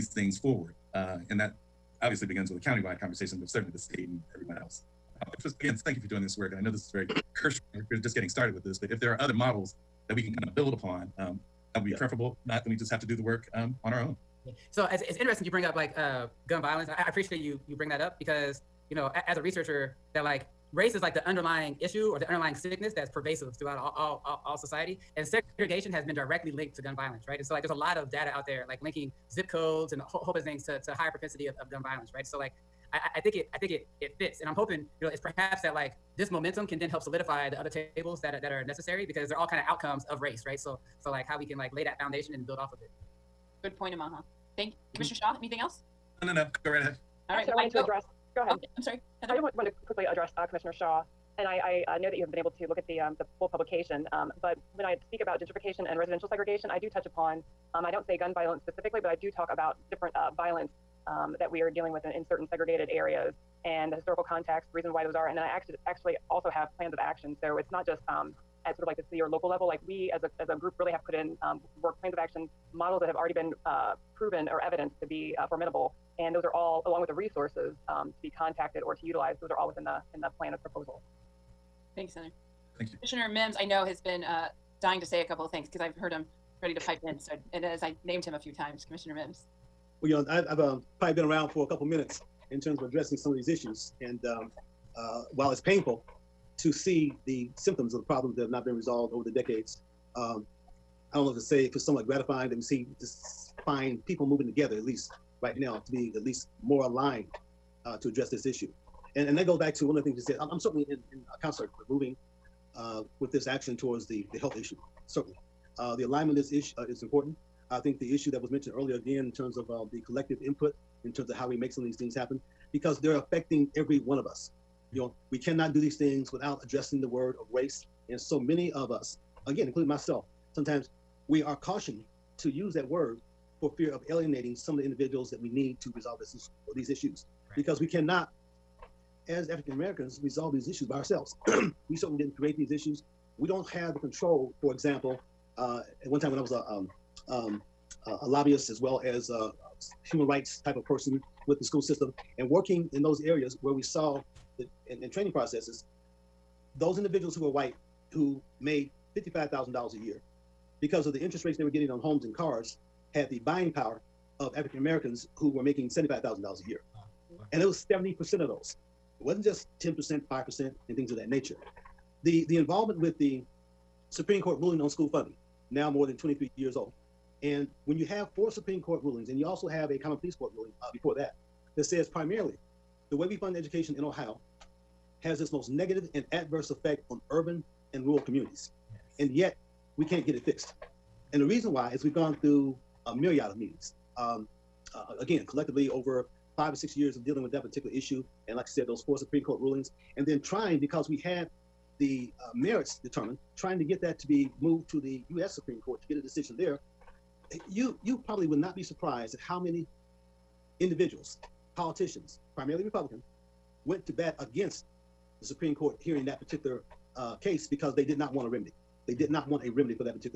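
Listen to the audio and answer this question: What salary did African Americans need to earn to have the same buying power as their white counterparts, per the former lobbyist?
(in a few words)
$75,000.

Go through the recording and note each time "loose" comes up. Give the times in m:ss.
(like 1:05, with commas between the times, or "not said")
not said.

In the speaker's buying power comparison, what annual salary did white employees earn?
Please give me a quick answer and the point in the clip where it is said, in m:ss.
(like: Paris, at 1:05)
$55,000, at 2:39.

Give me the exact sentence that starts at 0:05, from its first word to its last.
Uh, just again, thank you for doing this work.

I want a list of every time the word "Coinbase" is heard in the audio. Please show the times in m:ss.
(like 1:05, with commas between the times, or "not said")
not said.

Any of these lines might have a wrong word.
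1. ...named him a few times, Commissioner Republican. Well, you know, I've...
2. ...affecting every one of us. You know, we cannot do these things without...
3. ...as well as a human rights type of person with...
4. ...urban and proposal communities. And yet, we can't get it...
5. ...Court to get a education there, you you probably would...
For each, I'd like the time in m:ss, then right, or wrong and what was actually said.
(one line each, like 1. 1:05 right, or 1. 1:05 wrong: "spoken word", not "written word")
1. 1:28 wrong: "Mims", not "Republican"
2. 2:03 right
3. 2:28 right
4. 3:07 wrong: "rural", not "proposal"
5. 3:25 wrong: "decision", not "education".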